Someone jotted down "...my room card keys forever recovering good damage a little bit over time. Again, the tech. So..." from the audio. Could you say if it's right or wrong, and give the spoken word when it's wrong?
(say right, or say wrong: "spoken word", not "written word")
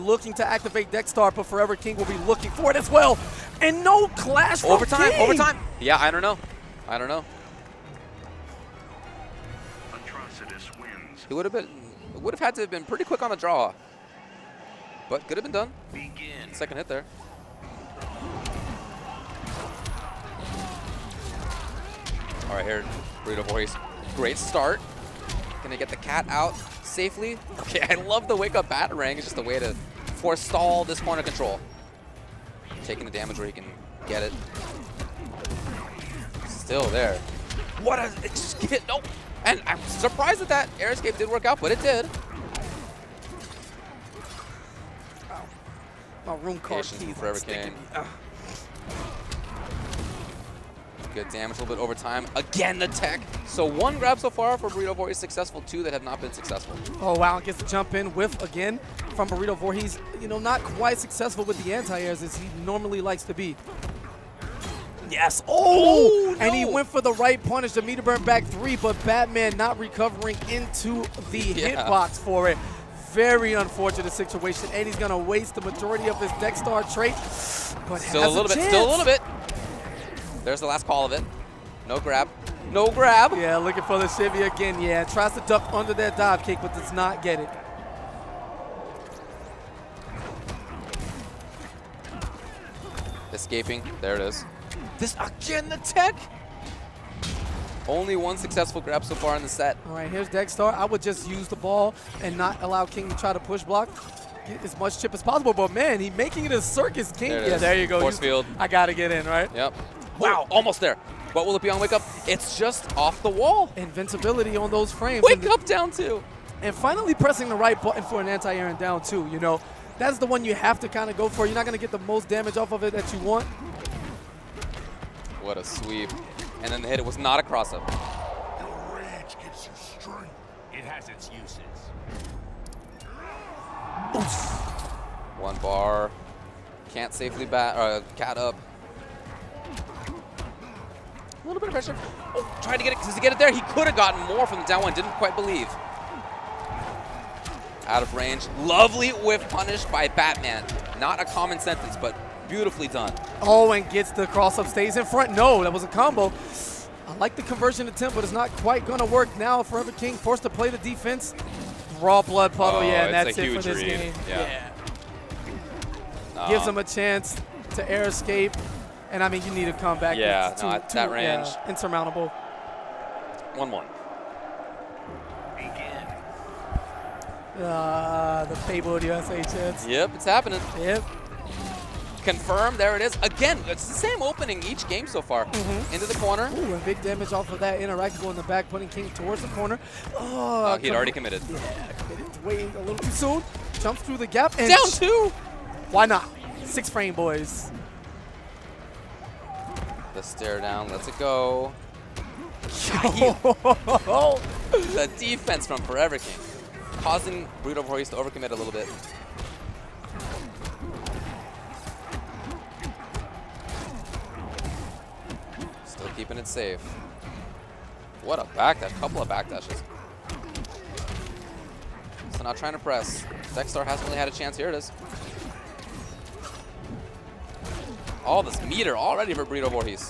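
wrong: "sticking", not "recovering".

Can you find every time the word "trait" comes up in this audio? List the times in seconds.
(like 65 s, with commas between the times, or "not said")
76 s.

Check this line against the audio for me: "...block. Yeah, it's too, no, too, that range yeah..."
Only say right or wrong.
wrong.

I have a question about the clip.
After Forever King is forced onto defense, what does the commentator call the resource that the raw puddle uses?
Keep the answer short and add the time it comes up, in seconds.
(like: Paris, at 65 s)
Blood, at 162 s.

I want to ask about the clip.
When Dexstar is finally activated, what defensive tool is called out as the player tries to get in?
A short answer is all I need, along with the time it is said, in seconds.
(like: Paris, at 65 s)
Force field, at 108 s.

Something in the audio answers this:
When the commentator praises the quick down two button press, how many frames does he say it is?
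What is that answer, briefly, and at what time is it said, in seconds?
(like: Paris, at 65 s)
6, at 196 s.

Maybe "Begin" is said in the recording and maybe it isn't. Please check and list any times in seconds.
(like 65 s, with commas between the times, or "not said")
15 s.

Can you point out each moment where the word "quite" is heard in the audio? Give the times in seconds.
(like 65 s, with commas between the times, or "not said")
60 s, 145 s, 158 s.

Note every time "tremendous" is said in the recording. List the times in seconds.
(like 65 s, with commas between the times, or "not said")
not said.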